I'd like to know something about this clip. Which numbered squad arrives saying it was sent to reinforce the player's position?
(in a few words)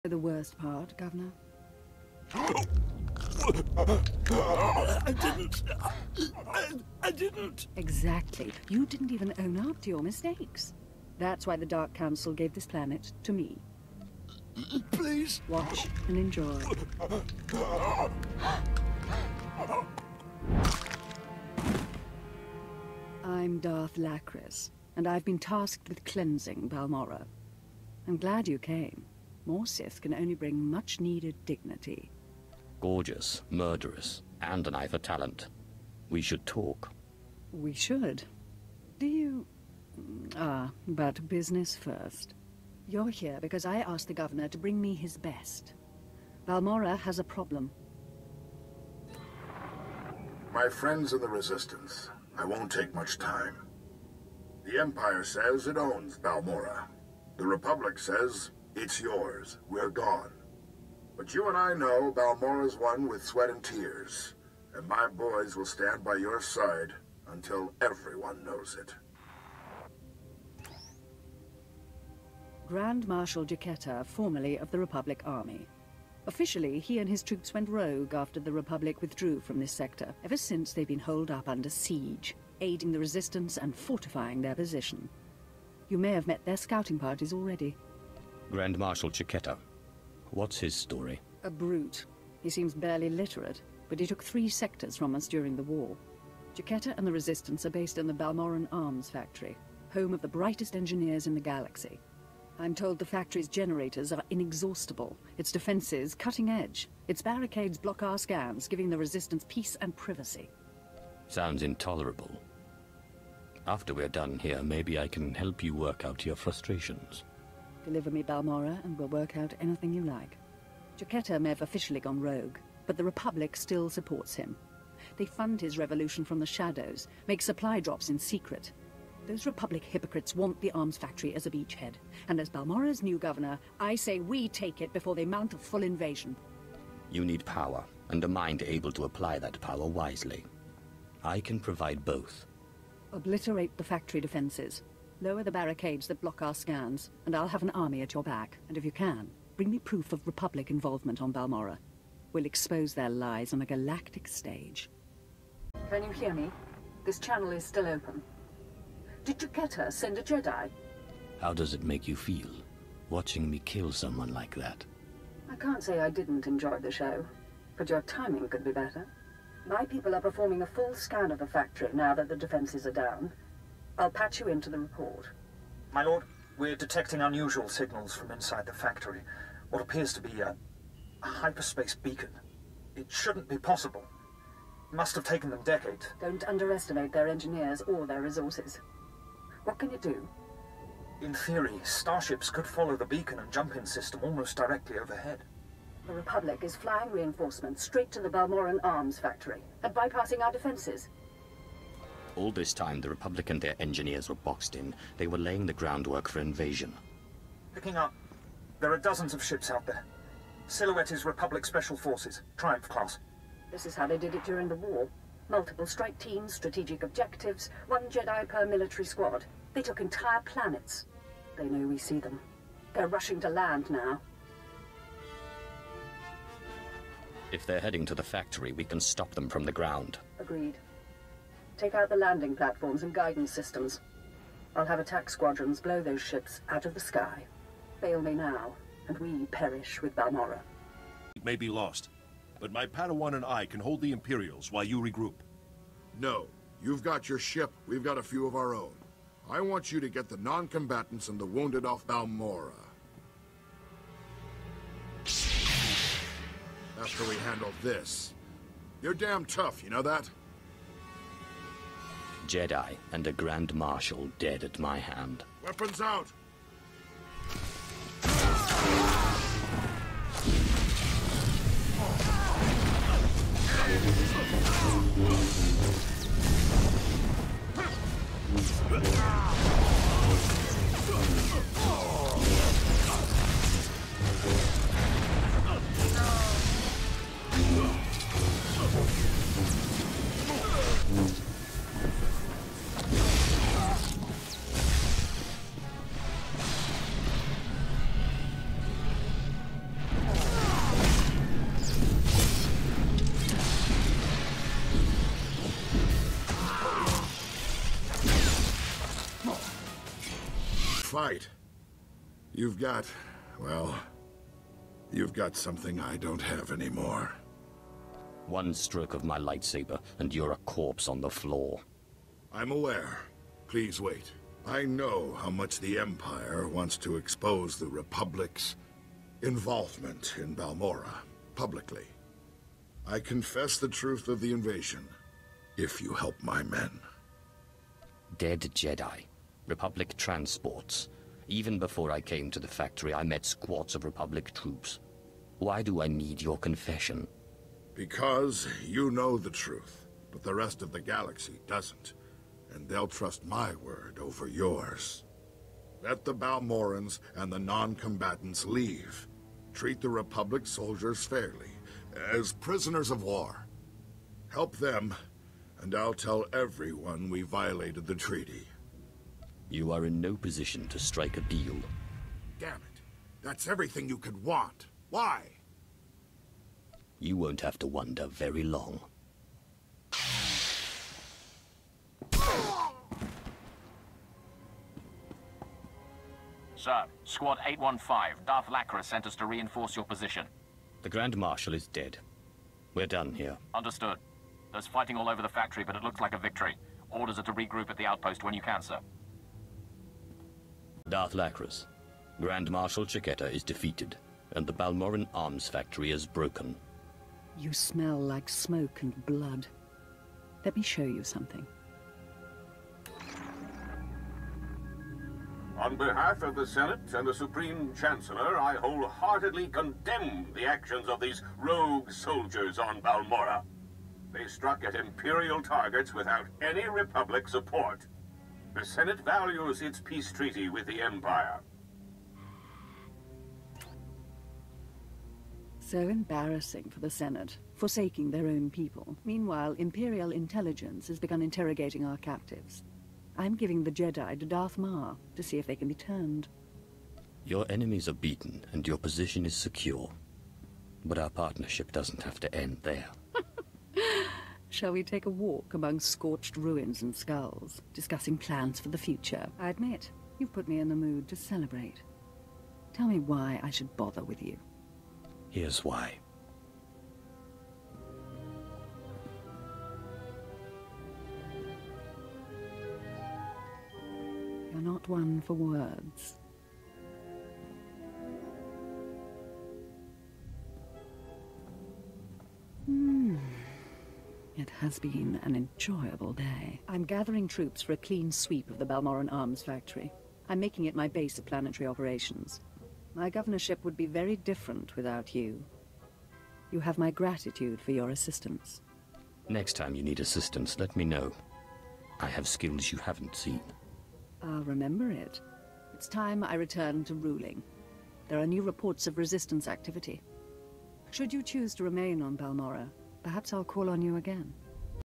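Squad 815.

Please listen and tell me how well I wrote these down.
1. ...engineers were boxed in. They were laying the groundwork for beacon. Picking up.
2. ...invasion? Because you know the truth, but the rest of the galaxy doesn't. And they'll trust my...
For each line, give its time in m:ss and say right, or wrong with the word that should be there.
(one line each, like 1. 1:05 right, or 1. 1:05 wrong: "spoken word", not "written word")
1. 3:23 wrong: "invasion", not "beacon"
2. 5:46 wrong: "confession", not "invasion".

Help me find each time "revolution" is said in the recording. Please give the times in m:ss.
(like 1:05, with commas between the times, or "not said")
2:05.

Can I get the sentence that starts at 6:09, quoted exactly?
You are in no position to strike a deal.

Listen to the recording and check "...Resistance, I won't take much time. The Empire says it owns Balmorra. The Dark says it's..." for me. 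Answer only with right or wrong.
wrong.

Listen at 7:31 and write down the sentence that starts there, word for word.
But our partnership doesn't have to end there.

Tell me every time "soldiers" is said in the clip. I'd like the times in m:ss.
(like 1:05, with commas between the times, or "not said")
6:00, 7:02.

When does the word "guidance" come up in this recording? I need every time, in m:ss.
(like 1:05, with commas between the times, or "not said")
3:53.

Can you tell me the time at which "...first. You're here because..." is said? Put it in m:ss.
0:41.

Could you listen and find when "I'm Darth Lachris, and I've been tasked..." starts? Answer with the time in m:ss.
0:23.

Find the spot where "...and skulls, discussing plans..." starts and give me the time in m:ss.
7:37.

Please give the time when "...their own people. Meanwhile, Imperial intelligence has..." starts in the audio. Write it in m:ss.
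7:18.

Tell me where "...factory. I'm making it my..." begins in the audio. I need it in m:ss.
8:09.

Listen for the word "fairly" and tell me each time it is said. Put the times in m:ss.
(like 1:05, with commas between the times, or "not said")
6:01.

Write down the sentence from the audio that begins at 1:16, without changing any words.
Officially, he and his troops went rogue after the Republic withdrew from this sector.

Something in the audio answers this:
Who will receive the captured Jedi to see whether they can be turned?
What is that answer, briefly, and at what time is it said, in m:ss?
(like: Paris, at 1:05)
Darth Mar, at 7:24.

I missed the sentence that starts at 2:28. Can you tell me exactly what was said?
And if you can, bring me proof of Republic involvement on Balmorra.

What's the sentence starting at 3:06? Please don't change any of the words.
Don't underestimate their engineers or their resources.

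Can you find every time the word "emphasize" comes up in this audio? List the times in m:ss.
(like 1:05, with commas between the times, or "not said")
not said.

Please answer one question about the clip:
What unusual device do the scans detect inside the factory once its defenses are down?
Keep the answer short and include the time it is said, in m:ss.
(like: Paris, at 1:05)
Hyperspace beacon, at 3:01.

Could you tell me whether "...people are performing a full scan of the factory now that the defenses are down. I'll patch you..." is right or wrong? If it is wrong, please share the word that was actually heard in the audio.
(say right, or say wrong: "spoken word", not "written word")
right.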